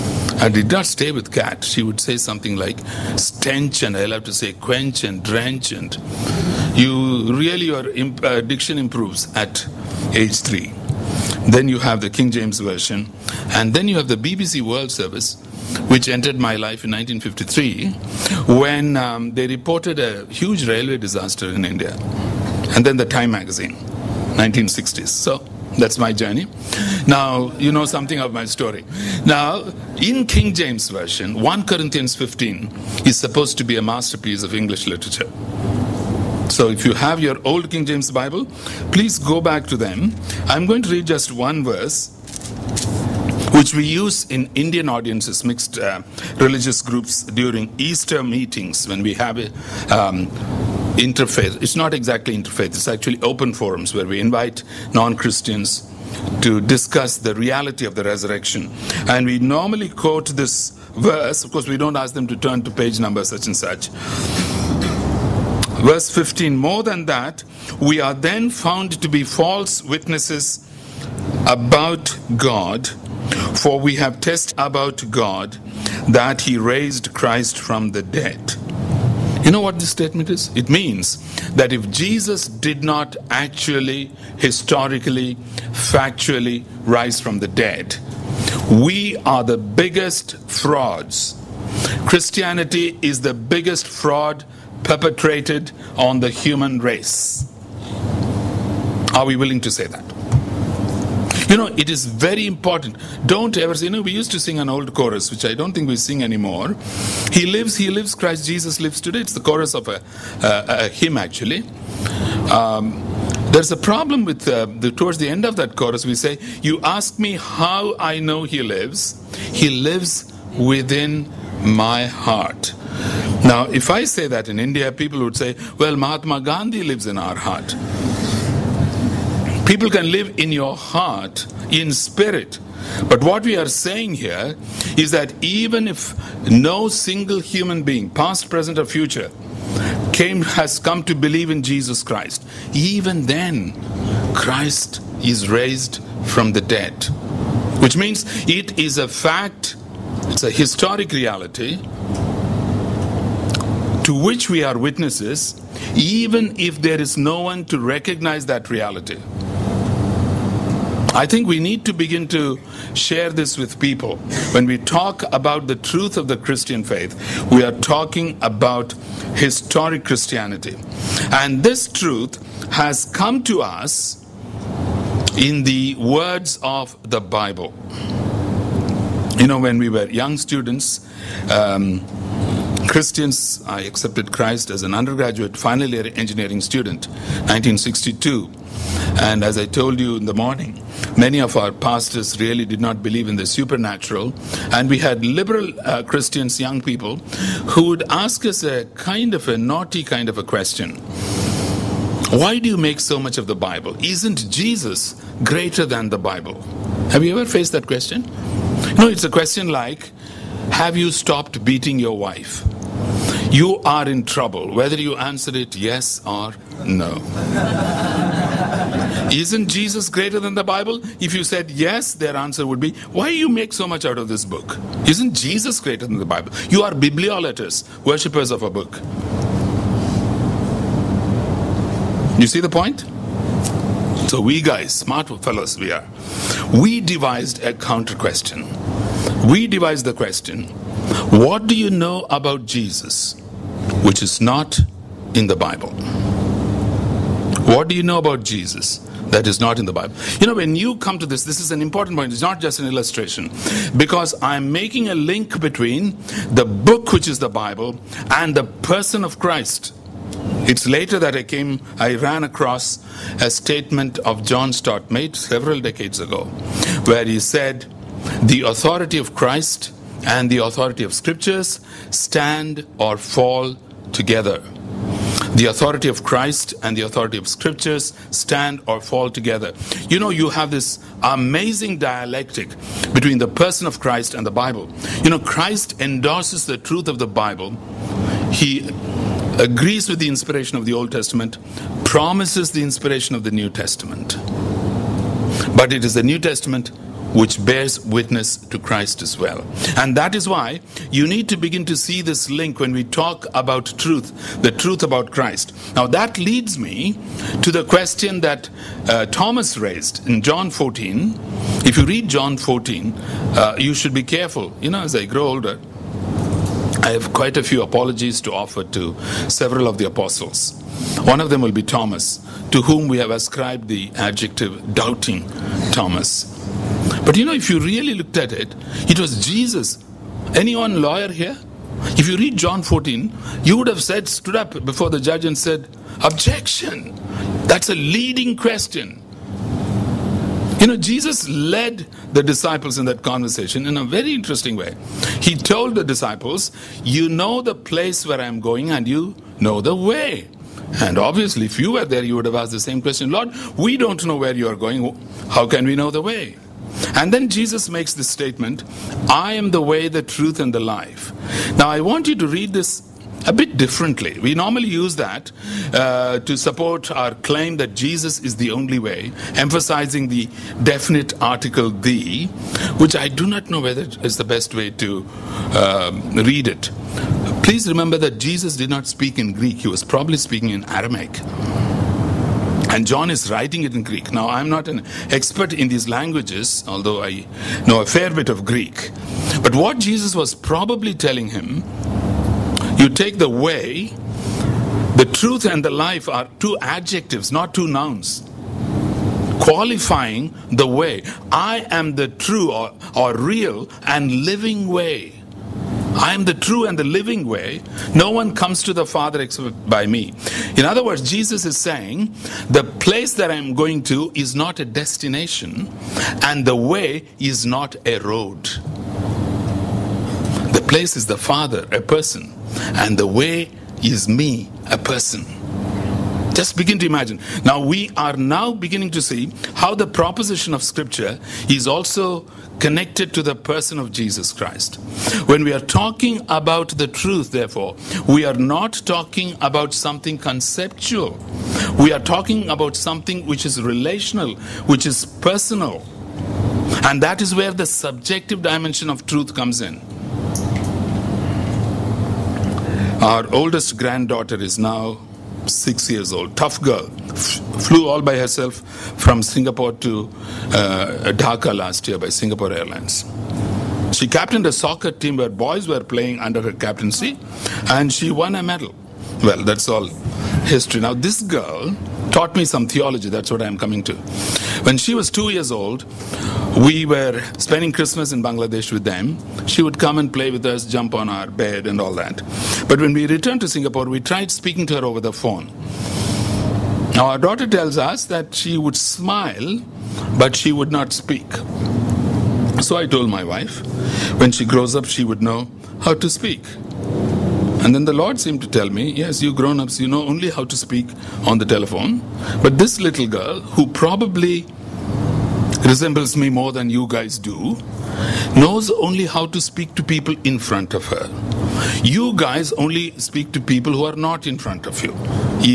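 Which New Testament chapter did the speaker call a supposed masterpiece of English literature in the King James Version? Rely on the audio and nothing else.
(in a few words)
1 Corinthians 15.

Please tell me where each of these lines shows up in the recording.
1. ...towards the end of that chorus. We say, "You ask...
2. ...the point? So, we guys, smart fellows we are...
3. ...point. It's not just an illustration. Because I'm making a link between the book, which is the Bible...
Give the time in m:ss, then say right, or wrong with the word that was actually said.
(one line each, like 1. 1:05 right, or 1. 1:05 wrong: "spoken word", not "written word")
1. 1:54 right
2. 3:52 right
3. 4:12 right.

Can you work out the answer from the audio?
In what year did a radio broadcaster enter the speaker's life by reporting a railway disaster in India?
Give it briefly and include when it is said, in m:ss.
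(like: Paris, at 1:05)
1953, at 0:16.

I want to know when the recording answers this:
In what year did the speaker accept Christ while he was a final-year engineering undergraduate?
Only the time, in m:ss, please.
3:07.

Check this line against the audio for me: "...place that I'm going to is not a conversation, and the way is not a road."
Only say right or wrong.
wrong.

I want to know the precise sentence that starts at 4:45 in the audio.
You know, Christ endorses the truth of the Bible.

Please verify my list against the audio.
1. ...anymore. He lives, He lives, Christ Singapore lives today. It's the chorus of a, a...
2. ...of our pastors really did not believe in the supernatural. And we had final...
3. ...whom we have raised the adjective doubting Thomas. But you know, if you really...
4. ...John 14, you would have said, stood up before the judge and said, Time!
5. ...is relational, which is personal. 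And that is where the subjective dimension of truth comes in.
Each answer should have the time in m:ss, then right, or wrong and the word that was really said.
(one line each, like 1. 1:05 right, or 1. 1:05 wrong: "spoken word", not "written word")
1. 1:46 wrong: "Jesus", not "Singapore"
2. 3:11 wrong: "liberal", not "final"
3. 5:22 wrong: "ascribed", not "raised"
4. 5:32 wrong: "Objection", not "Time"
5. 7:23 right.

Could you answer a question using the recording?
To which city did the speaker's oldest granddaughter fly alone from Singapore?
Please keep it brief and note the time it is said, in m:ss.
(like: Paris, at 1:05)
Dhaka, at 7:41.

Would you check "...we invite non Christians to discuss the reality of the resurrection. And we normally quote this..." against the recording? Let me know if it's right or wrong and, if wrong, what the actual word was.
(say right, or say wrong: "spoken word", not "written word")
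right.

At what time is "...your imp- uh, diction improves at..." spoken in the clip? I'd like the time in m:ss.
0:07.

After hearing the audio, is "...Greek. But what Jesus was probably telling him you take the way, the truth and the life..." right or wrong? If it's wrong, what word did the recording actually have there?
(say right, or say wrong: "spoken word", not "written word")
right.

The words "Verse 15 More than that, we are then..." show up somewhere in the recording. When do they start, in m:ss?
1:05.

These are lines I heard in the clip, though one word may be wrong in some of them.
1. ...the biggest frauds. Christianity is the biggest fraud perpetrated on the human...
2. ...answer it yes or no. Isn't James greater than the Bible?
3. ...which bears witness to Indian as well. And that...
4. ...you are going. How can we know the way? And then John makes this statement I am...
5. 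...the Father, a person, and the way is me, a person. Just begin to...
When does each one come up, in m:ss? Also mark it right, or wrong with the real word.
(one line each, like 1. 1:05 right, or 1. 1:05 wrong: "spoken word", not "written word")
1. 1:29 right
2. 3:35 wrong: "Jesus", not "James"
3. 4:57 wrong: "Christ", not "Indian"
4. 5:54 wrong: "Jesus", not "John"
5. 7:01 right.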